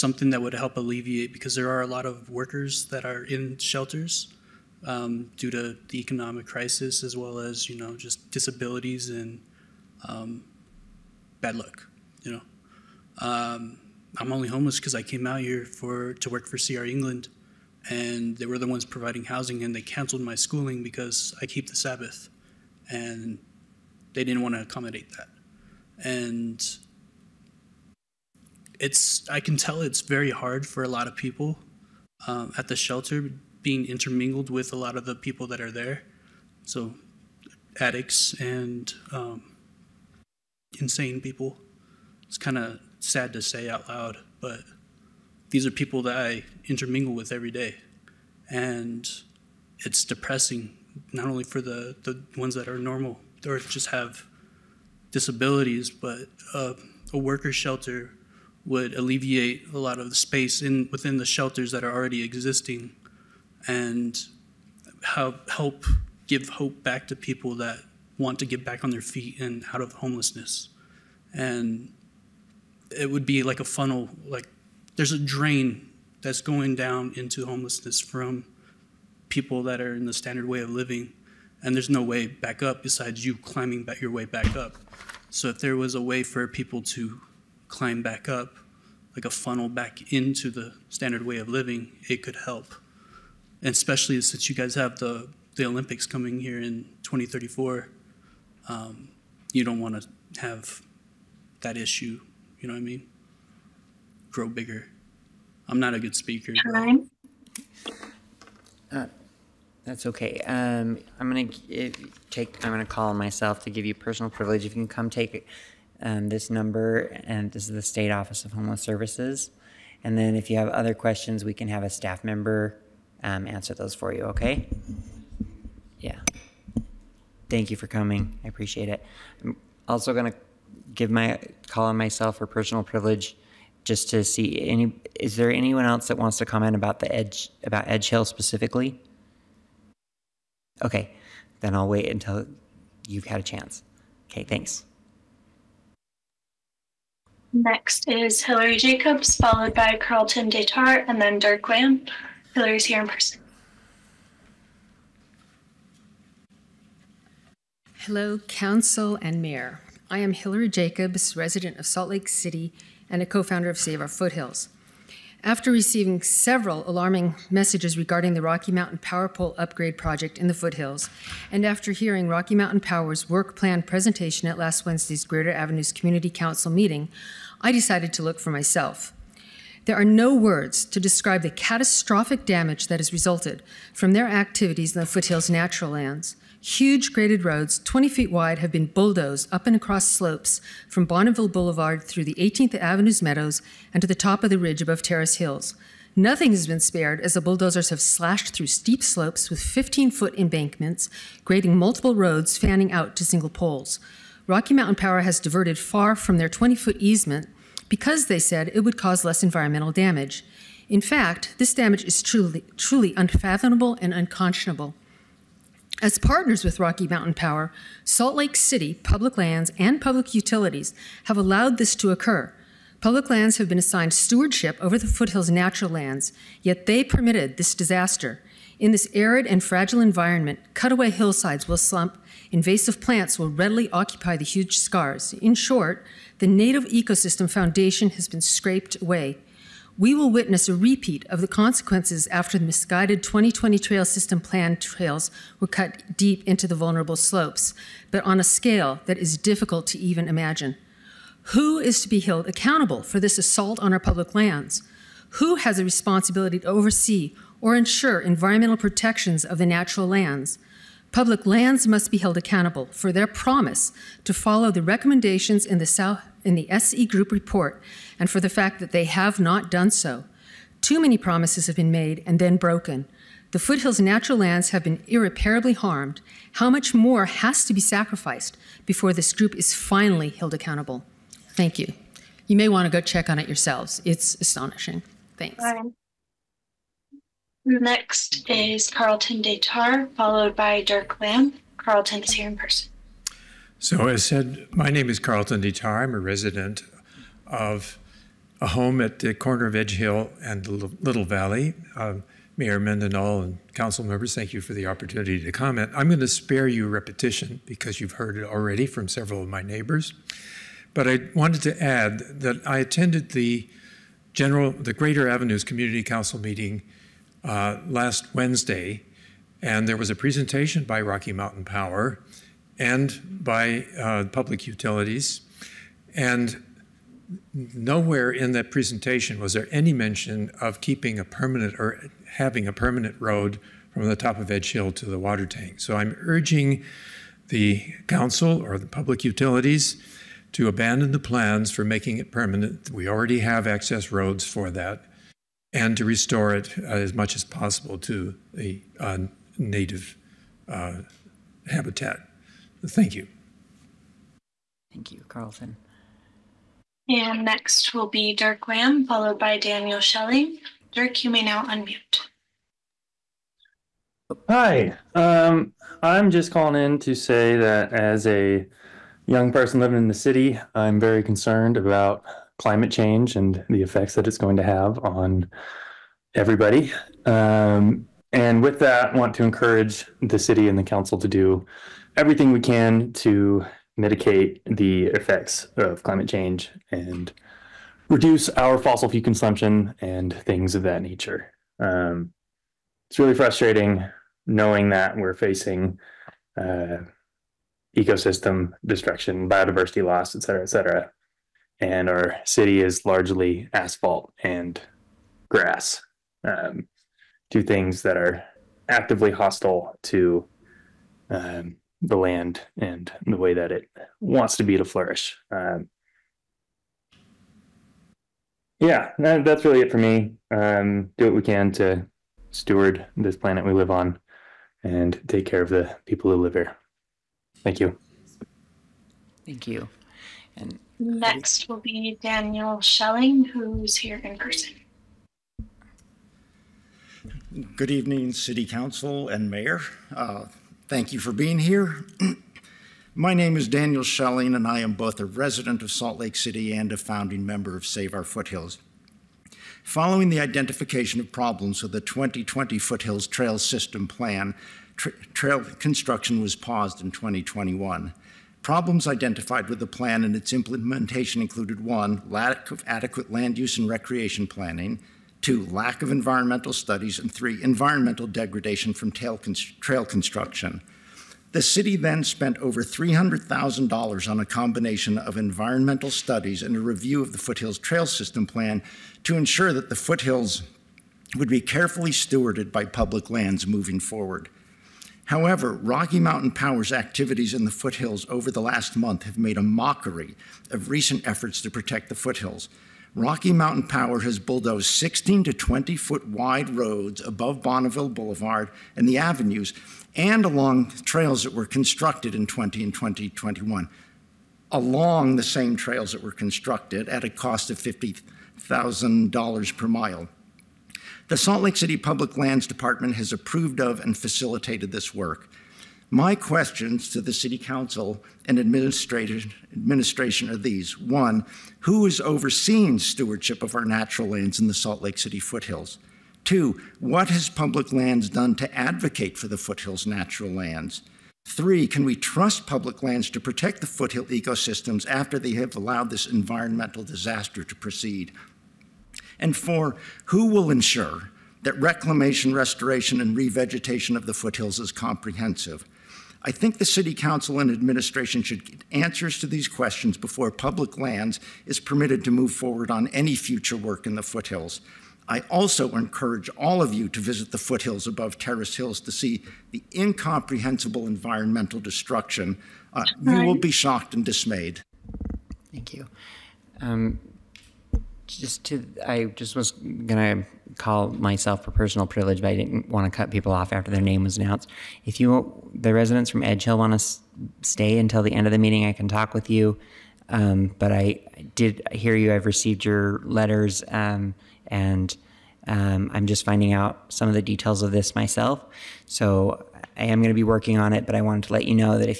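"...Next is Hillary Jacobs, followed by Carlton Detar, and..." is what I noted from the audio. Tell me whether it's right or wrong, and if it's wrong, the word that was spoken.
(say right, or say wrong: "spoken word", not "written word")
right.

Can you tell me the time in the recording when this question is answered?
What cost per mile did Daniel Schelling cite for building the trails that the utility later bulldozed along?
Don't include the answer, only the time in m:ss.
8:27.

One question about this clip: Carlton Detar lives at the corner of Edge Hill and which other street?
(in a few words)
Little Valley.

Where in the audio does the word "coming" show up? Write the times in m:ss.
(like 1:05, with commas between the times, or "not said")
1:36, 2:07.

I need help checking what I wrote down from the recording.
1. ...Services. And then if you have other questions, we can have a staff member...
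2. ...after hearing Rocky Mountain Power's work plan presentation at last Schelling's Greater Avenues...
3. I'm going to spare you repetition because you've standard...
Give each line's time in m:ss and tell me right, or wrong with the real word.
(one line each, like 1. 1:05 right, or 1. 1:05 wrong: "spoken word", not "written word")
1. 1:58 right
2. 2:51 wrong: "Wednesday", not "Schelling"
3. 5:05 wrong: "heard", not "standard".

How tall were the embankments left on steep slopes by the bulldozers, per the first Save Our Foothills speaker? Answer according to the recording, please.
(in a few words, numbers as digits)
15 feet.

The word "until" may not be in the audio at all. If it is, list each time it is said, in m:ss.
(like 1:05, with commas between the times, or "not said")
2:22, 9:37.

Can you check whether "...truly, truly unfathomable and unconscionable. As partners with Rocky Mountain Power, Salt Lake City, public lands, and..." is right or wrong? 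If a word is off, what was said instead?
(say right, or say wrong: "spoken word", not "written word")
right.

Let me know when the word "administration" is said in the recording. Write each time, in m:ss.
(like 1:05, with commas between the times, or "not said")
8:38, 9:07.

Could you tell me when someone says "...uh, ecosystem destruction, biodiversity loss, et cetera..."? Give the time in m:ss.
6:36.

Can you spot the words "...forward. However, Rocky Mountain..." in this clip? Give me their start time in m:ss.
8:03.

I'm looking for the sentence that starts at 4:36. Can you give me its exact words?
How much more has to be sacrificed before this group is finally held accountable?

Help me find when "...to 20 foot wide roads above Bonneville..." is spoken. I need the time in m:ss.
8:15.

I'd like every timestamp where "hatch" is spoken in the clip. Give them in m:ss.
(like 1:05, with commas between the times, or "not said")
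not said.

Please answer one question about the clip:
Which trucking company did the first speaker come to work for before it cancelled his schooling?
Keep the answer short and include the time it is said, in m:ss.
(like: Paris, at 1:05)
CR England, at 0:16.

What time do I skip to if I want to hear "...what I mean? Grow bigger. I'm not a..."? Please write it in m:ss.
1:42.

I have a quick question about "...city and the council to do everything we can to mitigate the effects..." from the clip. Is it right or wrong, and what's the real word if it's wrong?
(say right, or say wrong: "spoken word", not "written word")
right.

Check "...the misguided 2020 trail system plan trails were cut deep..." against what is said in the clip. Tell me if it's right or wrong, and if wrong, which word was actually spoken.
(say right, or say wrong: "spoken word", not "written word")
right.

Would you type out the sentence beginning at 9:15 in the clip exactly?
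I also encourage all of you to visit the foothills above Terrace Hills to see the incomprehensible environmental destruction.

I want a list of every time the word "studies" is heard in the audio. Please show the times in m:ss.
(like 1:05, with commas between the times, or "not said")
7:46, 7:56.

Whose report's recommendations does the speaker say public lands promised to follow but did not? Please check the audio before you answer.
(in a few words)
SE Group.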